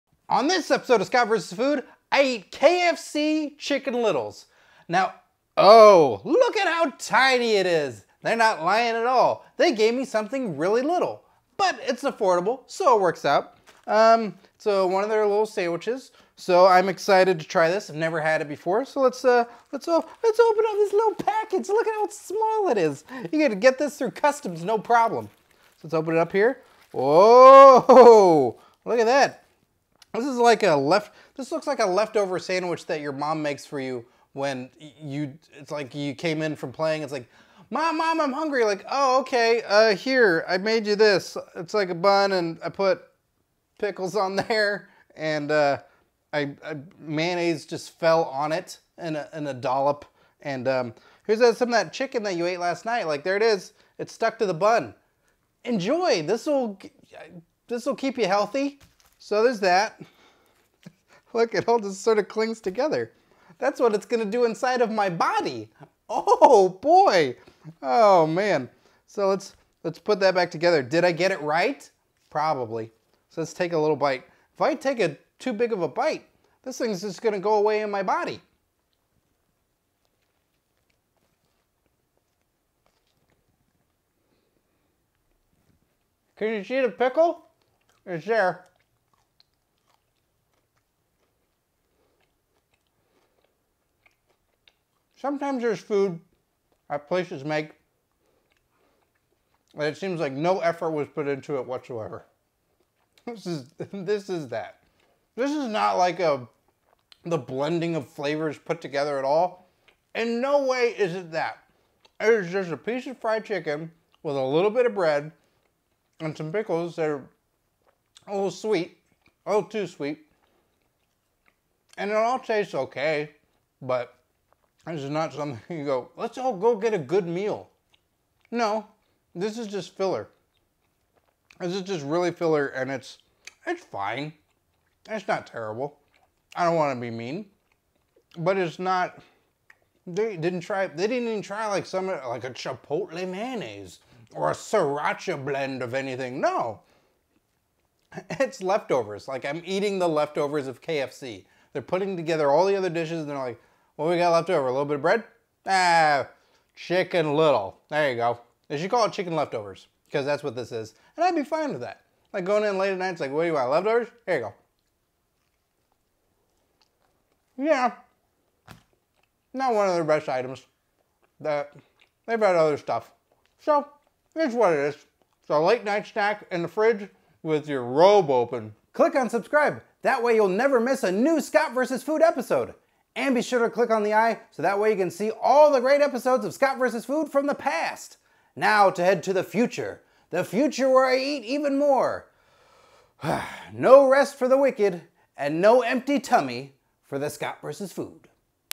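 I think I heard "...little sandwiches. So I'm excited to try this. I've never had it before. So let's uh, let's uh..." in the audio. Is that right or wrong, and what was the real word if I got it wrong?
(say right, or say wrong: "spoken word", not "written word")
right.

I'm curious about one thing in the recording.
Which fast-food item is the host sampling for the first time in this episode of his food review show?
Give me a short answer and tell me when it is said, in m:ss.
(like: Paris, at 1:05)
KFC Chicken Littles, at 0:02.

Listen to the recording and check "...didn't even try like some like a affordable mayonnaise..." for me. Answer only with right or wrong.
wrong.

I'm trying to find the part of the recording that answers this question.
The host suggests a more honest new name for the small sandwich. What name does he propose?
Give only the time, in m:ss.
2:39.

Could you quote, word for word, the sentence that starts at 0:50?
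And um, here's that, some of that chicken that you ate last night.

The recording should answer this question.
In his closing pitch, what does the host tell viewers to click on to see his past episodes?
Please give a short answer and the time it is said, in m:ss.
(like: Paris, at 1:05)
the eye, at 3:04.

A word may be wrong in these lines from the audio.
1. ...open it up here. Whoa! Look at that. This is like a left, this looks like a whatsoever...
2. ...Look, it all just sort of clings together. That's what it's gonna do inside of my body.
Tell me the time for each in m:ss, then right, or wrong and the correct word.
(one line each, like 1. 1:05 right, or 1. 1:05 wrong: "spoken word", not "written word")
1. 0:25 wrong: "leftover", not "whatsoever"
2. 1:01 right.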